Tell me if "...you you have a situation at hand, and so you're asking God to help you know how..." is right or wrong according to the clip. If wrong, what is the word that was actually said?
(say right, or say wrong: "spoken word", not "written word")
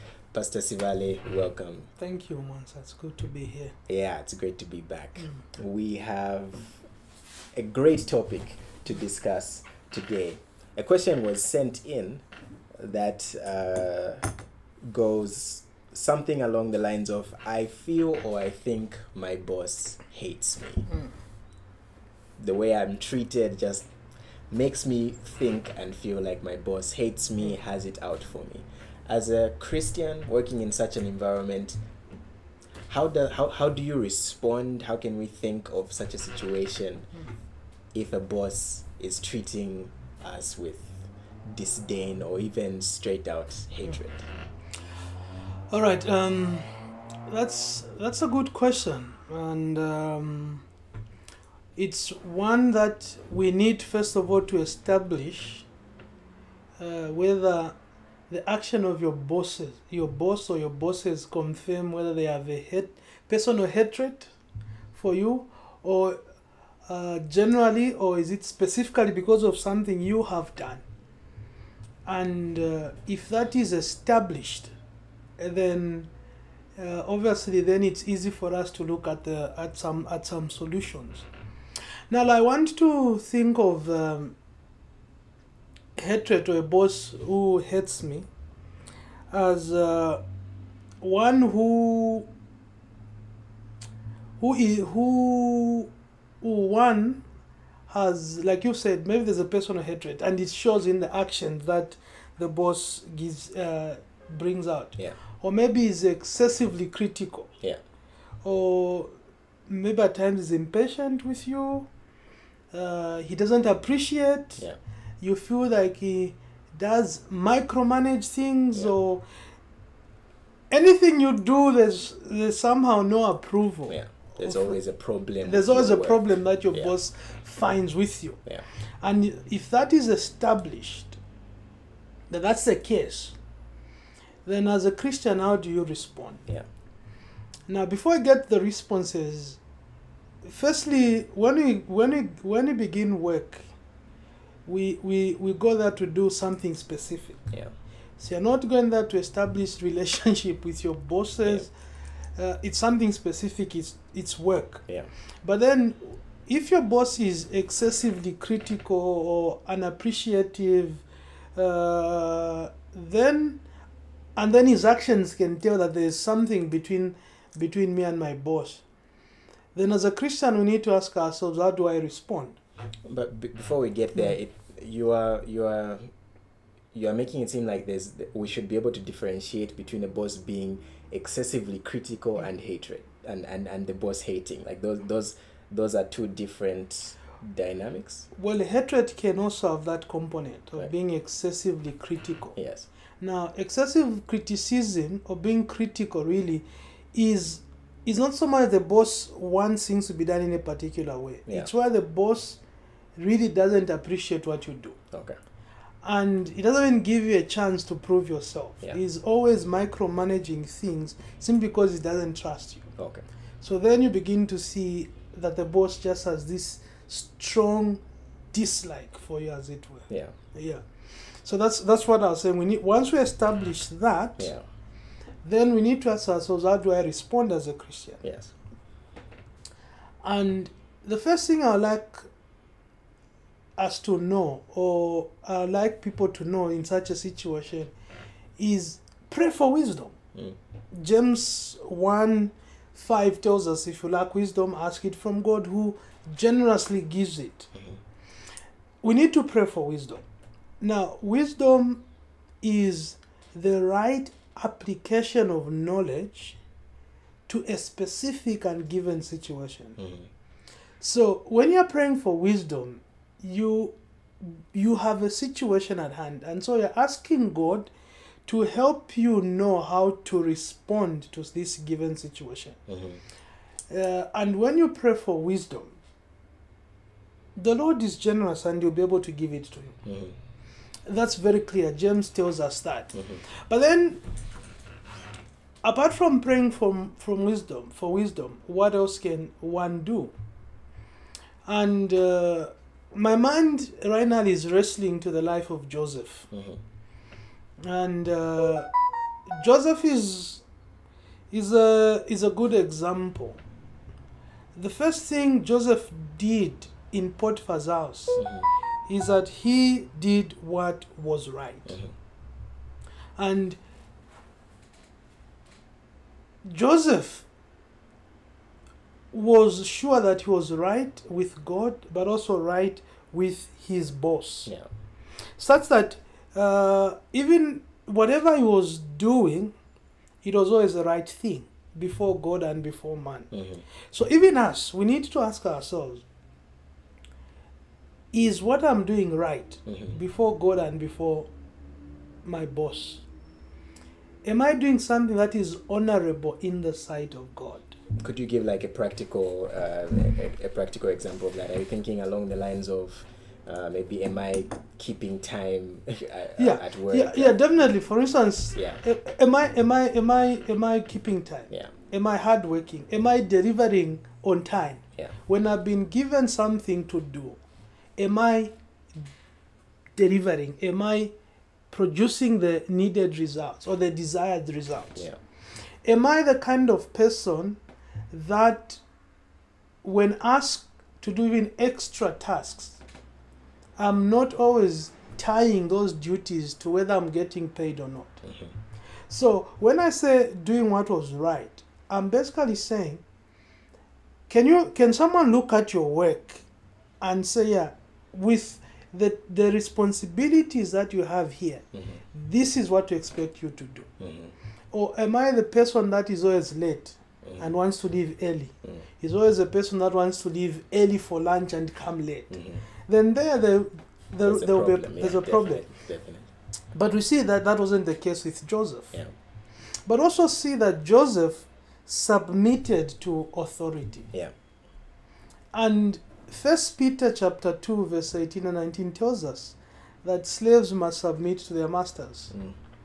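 right.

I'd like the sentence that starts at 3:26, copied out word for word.
And it doesn't even give you a chance to prove yourself.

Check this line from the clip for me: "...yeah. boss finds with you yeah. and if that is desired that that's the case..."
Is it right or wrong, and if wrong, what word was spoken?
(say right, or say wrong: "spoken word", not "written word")
wrong: "established", not "desired".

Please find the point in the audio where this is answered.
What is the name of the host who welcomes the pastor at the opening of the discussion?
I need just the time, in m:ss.
0:02.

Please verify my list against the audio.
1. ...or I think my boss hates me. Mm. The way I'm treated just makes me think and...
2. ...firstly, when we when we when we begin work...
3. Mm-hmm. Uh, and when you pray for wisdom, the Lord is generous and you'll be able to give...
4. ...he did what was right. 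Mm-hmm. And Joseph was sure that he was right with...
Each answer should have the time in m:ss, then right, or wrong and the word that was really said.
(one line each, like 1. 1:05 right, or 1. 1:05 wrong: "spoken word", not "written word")
1. 0:18 right
2. 2:20 right
3. 4:32 right
4. 5:09 right.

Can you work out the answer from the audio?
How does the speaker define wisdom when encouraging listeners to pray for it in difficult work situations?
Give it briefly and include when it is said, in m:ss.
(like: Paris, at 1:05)
Right application of knowledge, at 4:13.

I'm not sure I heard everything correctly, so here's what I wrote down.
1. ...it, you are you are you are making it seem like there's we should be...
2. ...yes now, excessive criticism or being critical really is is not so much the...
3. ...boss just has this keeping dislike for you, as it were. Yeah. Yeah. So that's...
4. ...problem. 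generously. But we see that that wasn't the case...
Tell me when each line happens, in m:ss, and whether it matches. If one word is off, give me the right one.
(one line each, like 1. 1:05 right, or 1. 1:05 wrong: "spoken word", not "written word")
1. 2:54 right
2. 3:12 right
3. 3:35 wrong: "strong", not "keeping"
4. 6:55 wrong: "definitely", not "generously".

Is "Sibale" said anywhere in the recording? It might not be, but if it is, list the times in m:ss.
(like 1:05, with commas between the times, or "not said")
0:00.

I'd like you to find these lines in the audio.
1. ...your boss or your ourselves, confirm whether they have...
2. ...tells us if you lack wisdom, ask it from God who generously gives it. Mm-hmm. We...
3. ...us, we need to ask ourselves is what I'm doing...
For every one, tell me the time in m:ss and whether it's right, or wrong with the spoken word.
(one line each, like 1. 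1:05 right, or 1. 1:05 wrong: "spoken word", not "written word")
1. 0:59 wrong: "bosses", not "ourselves"
2. 4:03 right
3. 5:34 right.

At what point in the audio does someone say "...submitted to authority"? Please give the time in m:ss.
7:02.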